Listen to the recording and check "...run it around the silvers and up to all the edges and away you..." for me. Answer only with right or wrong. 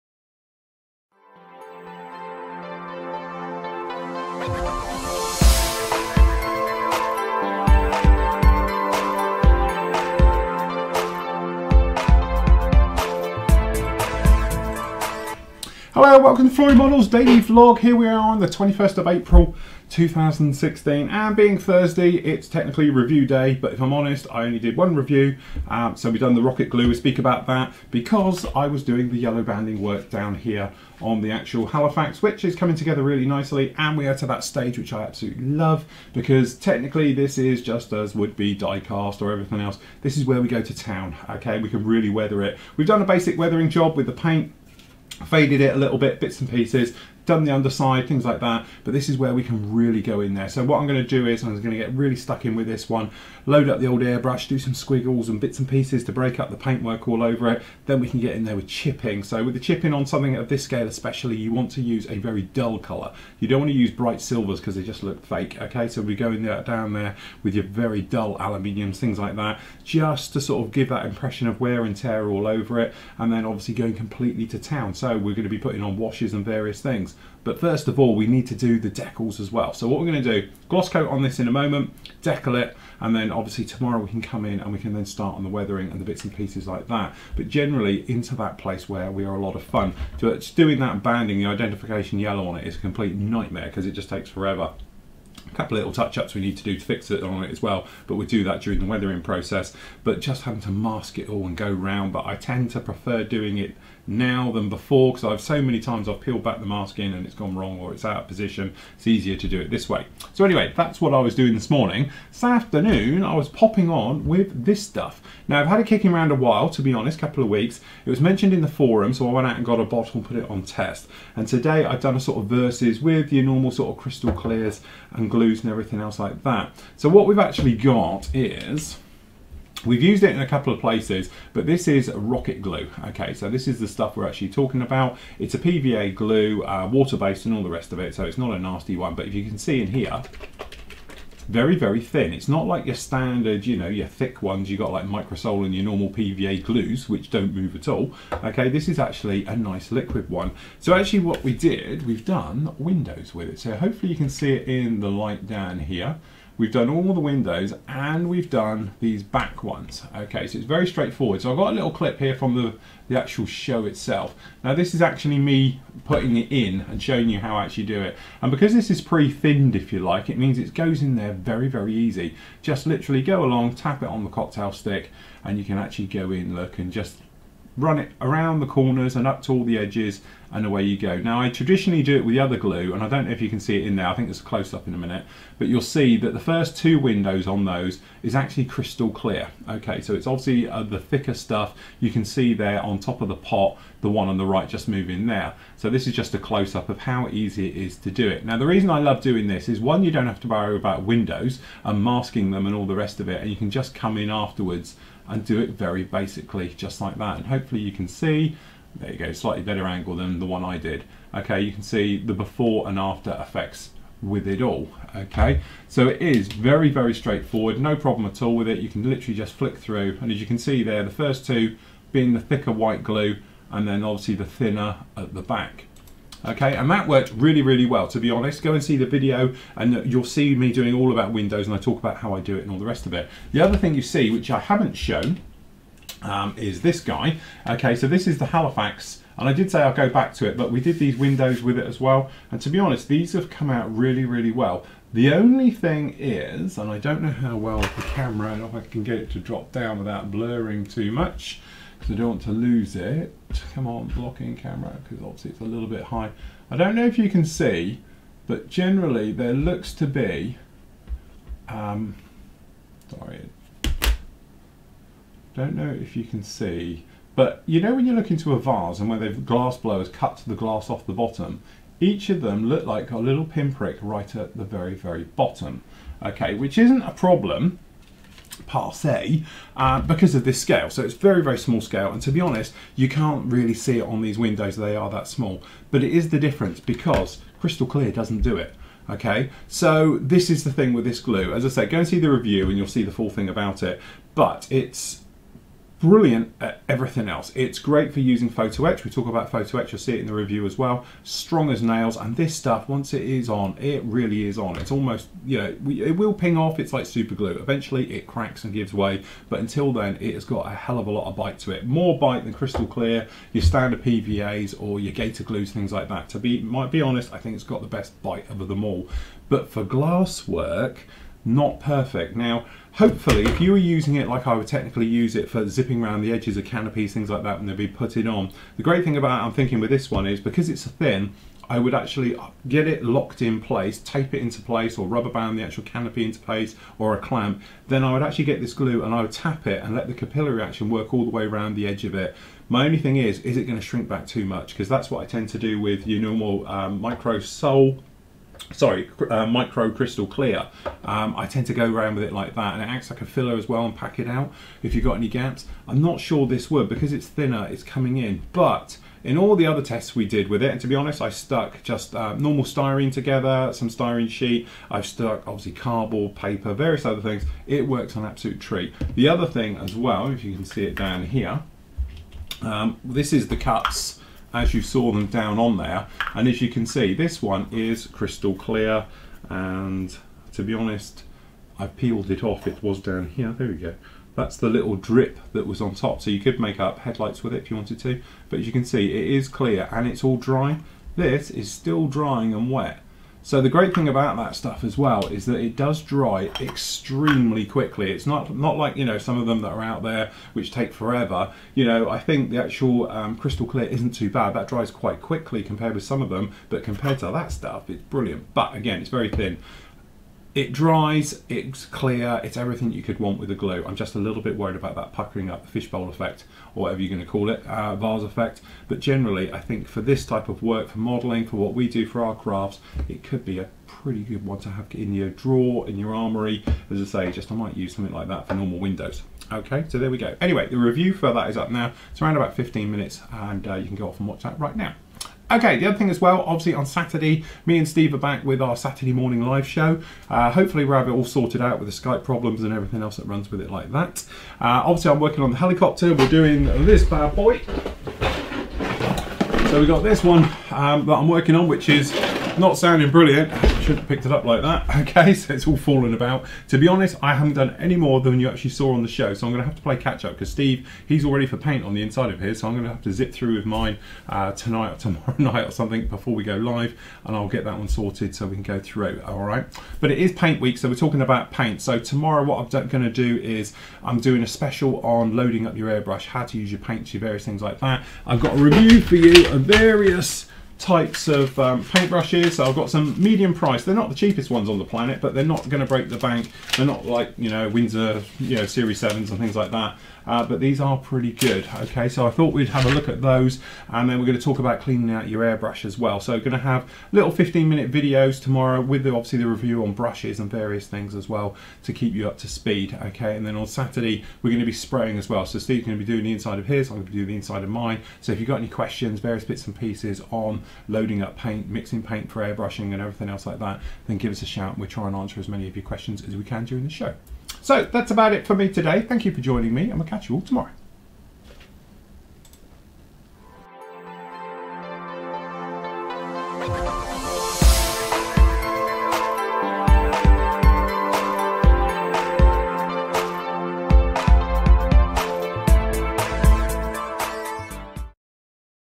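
wrong.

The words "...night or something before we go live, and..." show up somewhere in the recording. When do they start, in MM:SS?
07:45.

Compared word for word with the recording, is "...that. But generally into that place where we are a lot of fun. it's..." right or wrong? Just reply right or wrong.
right.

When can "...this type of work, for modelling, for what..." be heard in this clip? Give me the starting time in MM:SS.
07:00.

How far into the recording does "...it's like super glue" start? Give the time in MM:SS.
05:06.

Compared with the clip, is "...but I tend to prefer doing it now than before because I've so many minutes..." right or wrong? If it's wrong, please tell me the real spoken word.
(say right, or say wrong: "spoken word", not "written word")
wrong: "times", not "minutes".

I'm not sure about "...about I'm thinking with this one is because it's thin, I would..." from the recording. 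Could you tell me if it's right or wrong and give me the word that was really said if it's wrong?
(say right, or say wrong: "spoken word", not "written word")
right.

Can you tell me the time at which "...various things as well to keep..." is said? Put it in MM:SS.
08:20.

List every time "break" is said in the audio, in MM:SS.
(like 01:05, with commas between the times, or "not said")
00:56, 08:05.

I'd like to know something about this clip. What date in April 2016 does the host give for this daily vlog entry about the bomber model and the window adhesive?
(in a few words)
21st.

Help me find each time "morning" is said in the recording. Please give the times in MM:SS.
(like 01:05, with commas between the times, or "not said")
01:51, 07:19.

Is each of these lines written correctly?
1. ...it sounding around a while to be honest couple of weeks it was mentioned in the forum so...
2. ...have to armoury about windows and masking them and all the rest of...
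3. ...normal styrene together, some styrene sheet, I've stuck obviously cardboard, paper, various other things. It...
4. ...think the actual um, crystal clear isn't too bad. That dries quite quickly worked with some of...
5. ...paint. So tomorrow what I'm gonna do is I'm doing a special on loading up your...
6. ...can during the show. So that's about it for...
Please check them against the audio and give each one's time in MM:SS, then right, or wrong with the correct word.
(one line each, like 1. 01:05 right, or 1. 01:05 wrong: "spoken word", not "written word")
1. 01:55 wrong: "kicking", not "sounding"
2. 03:20 wrong: "worry", not "armoury"
3. 06:02 right
4. 06:42 wrong: "compared", not "worked"
5. 07:51 right
6. 08:36 right.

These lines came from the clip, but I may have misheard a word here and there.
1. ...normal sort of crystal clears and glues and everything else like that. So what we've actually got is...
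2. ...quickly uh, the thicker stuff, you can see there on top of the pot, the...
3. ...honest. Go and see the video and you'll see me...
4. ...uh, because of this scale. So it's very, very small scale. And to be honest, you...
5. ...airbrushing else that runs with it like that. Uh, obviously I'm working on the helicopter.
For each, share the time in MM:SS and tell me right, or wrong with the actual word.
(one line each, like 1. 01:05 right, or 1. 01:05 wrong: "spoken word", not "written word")
1. 02:03 right
2. 03:10 wrong: "obviously", not "quickly"
3. 03:48 right
4. 04:39 right
5. 07:22 wrong: "everything", not "airbrushing".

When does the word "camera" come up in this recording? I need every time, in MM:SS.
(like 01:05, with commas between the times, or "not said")
04:08, 04:14.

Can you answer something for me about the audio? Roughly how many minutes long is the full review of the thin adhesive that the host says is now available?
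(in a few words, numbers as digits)
15.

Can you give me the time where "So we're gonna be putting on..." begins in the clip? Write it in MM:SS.
01:14.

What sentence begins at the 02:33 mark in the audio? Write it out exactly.
So hopefully you can see it in the light down here.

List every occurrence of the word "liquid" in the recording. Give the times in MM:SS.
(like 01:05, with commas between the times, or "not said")
02:29.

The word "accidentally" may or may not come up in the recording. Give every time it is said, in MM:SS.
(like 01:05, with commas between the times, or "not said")
not said.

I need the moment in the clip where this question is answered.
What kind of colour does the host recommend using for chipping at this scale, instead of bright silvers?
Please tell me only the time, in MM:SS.
01:08.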